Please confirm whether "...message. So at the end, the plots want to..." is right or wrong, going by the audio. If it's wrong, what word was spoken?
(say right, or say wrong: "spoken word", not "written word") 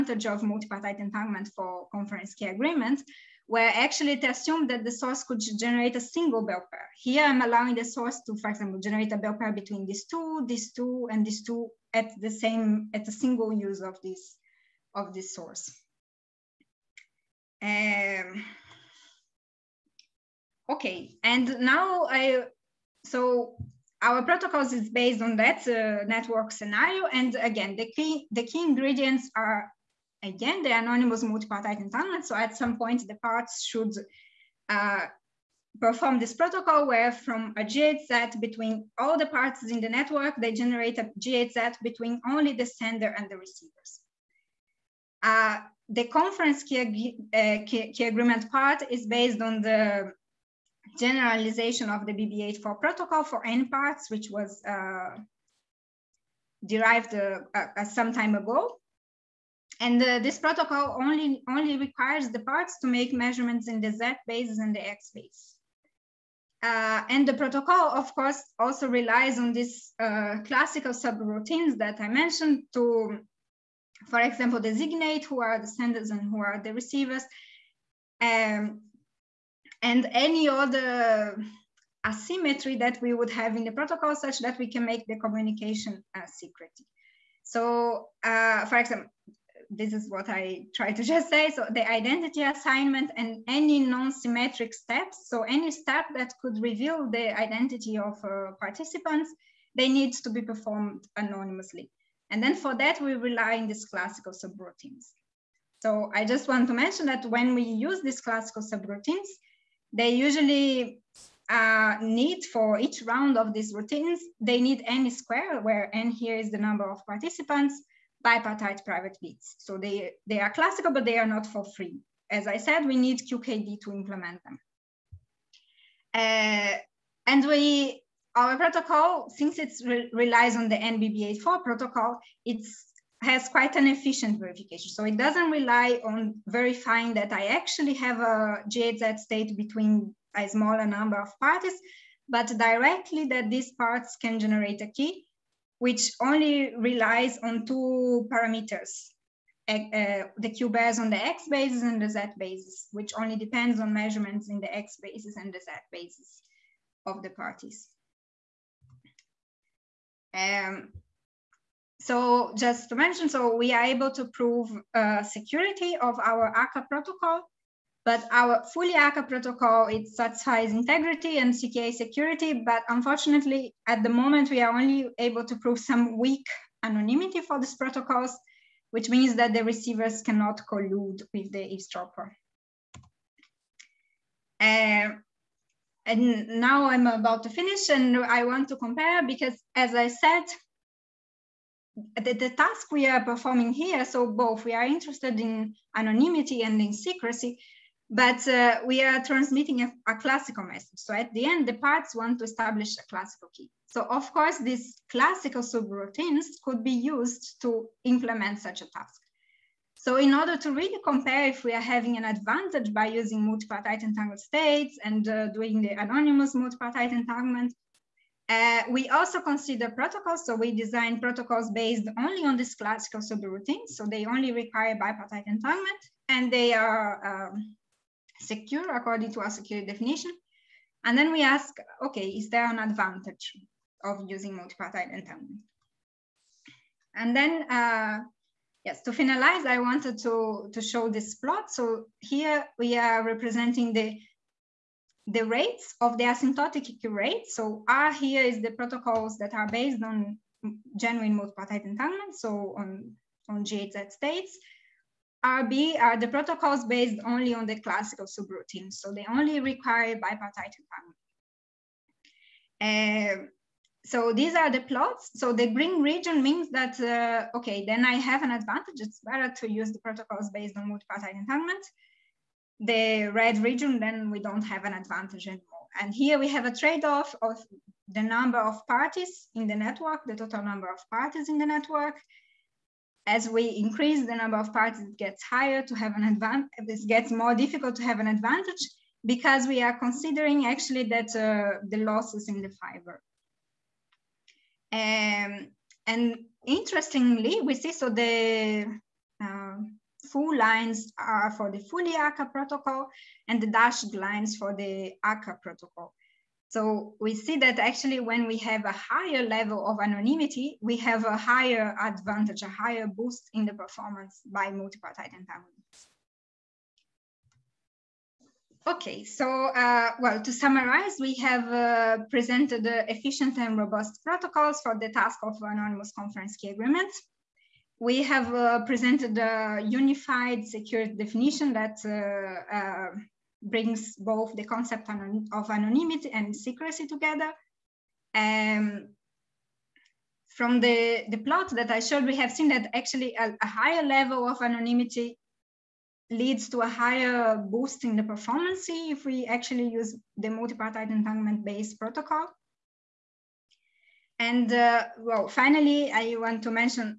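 wrong: "parts", not "plots".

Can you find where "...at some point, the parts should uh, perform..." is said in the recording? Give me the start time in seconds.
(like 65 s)
32 s.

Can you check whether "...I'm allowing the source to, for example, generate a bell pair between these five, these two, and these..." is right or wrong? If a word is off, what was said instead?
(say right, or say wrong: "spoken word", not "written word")
wrong: "two", not "five".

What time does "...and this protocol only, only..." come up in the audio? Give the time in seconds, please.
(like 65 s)
59 s.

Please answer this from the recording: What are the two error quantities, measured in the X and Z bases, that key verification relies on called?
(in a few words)
QBERs.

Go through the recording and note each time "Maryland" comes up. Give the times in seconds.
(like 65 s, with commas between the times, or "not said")
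not said.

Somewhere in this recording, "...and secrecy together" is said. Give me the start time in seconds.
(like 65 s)
336 s.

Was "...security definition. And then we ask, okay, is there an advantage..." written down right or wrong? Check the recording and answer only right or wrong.
right.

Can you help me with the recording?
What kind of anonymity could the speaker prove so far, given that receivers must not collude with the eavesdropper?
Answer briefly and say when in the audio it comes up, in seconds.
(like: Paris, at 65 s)
weak anonymity, at 176 s.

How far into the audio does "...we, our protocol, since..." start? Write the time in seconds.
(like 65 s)
127 s.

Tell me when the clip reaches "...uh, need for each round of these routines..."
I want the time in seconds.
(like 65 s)
111 s.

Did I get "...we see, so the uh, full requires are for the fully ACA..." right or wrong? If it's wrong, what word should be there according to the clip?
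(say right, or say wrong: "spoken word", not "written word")
wrong: "lines", not "requires".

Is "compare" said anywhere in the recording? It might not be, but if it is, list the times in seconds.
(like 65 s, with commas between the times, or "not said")
188 s, 211 s.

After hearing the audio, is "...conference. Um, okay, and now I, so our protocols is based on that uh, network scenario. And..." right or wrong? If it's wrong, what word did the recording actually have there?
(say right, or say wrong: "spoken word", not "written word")
wrong: "source", not "conference".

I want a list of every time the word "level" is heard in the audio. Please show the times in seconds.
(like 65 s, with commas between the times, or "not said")
309 s, 344 s.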